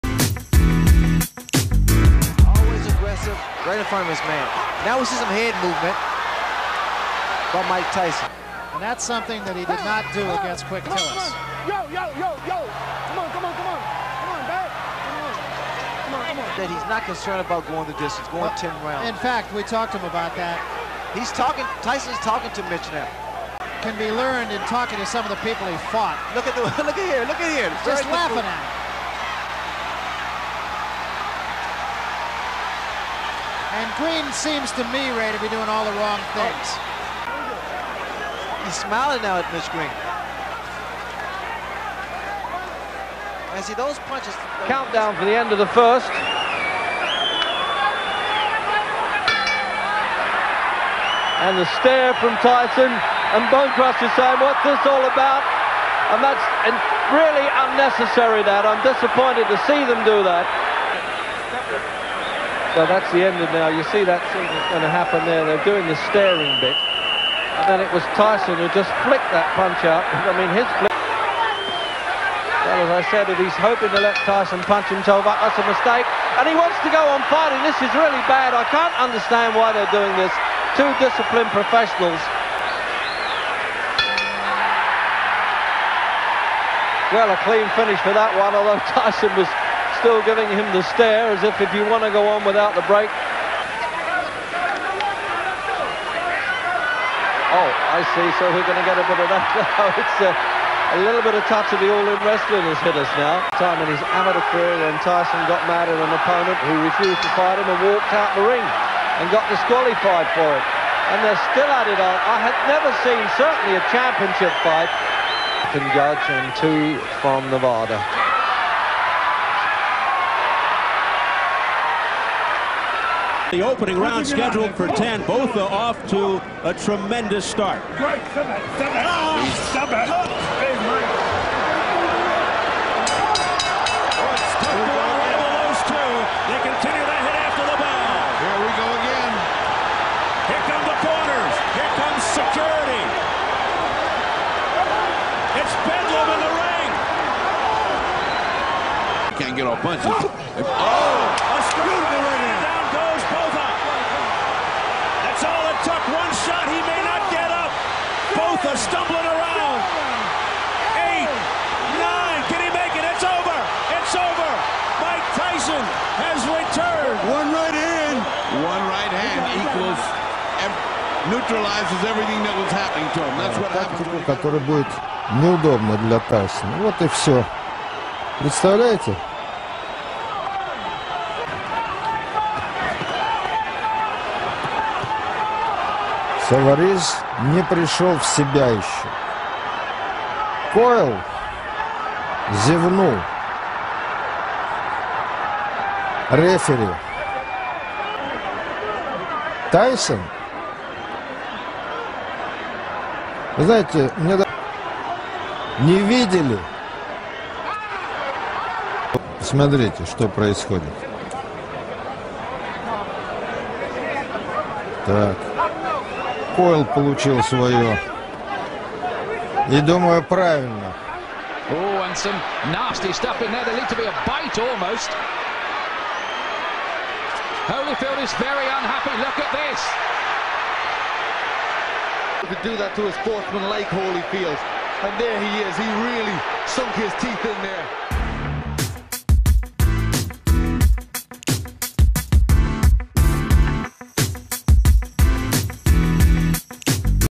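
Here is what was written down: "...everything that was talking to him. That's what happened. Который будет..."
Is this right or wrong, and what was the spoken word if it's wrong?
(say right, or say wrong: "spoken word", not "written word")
wrong: "happening", not "talking".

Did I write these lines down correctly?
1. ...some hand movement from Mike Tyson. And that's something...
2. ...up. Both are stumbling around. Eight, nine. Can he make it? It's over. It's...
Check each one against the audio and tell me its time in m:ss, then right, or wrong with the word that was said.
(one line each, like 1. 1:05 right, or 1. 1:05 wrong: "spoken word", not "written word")
1. 0:05 right
2. 2:37 right.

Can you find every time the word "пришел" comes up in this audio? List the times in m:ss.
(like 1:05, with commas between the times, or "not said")
3:07.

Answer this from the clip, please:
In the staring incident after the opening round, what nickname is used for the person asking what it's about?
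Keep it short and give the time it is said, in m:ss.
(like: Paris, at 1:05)
Bonecrust, at 0:53.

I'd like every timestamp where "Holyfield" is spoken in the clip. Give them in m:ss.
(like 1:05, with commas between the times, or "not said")
3:47, 3:53.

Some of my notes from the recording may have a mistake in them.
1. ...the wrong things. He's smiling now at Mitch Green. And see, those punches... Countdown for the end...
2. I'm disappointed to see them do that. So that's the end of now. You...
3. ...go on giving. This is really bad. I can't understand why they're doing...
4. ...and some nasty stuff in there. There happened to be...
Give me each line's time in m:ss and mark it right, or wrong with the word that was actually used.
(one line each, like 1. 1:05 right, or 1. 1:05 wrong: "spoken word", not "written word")
1. 0:35 right
2. 0:58 right
3. 1:16 wrong: "fighting", not "giving"
4. 3:42 wrong: "looked", not "happened".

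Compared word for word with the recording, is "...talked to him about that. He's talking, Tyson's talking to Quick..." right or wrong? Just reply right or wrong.
wrong.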